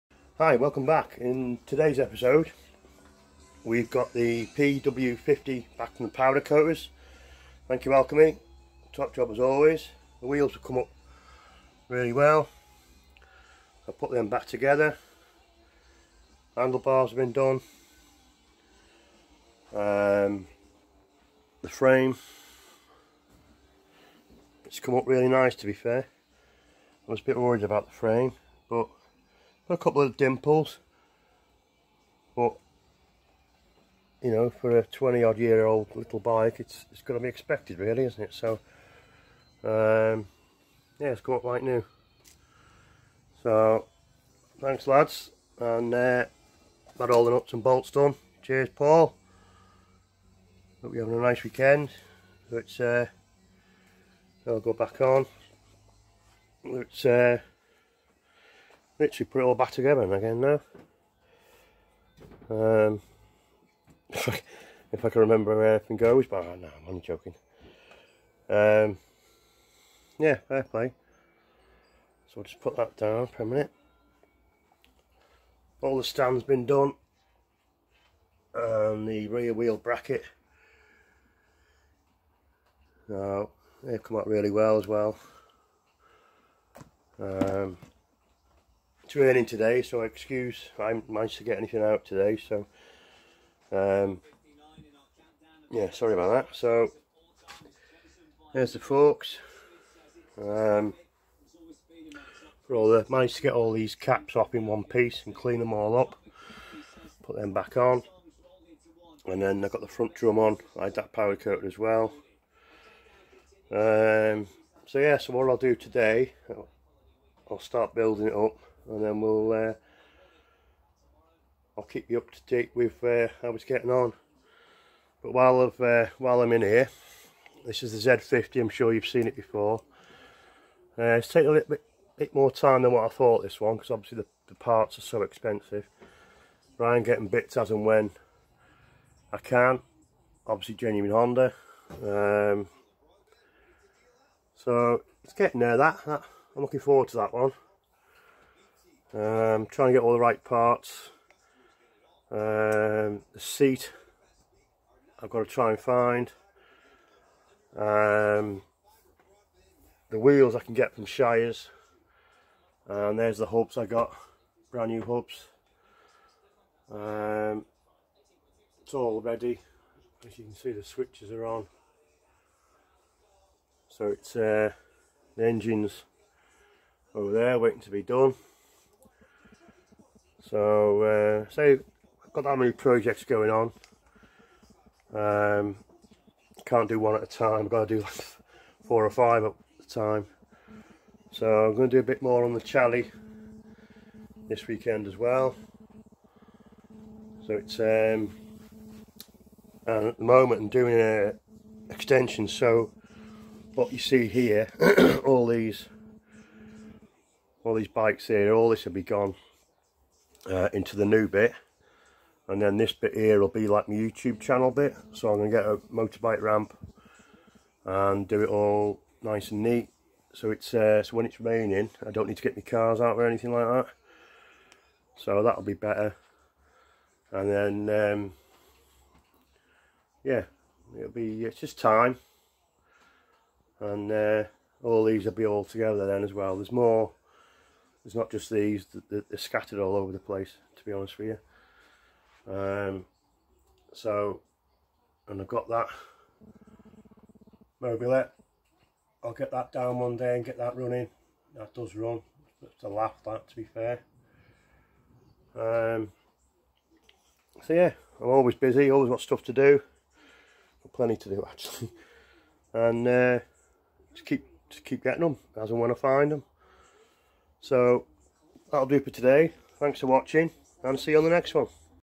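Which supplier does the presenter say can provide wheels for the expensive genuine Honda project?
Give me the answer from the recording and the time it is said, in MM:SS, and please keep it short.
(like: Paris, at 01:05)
Shires, at 02:41.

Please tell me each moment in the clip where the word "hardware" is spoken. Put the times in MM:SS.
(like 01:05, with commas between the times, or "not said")
not said.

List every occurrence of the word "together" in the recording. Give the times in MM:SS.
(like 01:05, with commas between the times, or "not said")
00:14, 00:59, 03:55.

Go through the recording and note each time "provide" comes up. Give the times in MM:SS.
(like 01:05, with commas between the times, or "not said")
not said.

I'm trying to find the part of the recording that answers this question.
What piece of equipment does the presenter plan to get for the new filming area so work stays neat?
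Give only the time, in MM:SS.
03:35.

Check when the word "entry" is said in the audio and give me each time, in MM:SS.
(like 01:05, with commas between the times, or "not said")
not said.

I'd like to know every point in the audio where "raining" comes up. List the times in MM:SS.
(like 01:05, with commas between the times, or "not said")
01:29, 03:41.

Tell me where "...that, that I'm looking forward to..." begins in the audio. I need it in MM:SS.
02:25.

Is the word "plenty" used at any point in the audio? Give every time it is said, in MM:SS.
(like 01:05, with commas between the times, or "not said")
04:20.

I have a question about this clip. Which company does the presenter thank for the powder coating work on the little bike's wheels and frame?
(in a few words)
Alkemi.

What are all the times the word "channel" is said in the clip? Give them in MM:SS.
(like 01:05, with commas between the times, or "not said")
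03:34.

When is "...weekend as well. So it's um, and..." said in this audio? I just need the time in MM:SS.
03:14.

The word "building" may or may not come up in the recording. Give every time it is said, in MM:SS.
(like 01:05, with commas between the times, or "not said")
01:57.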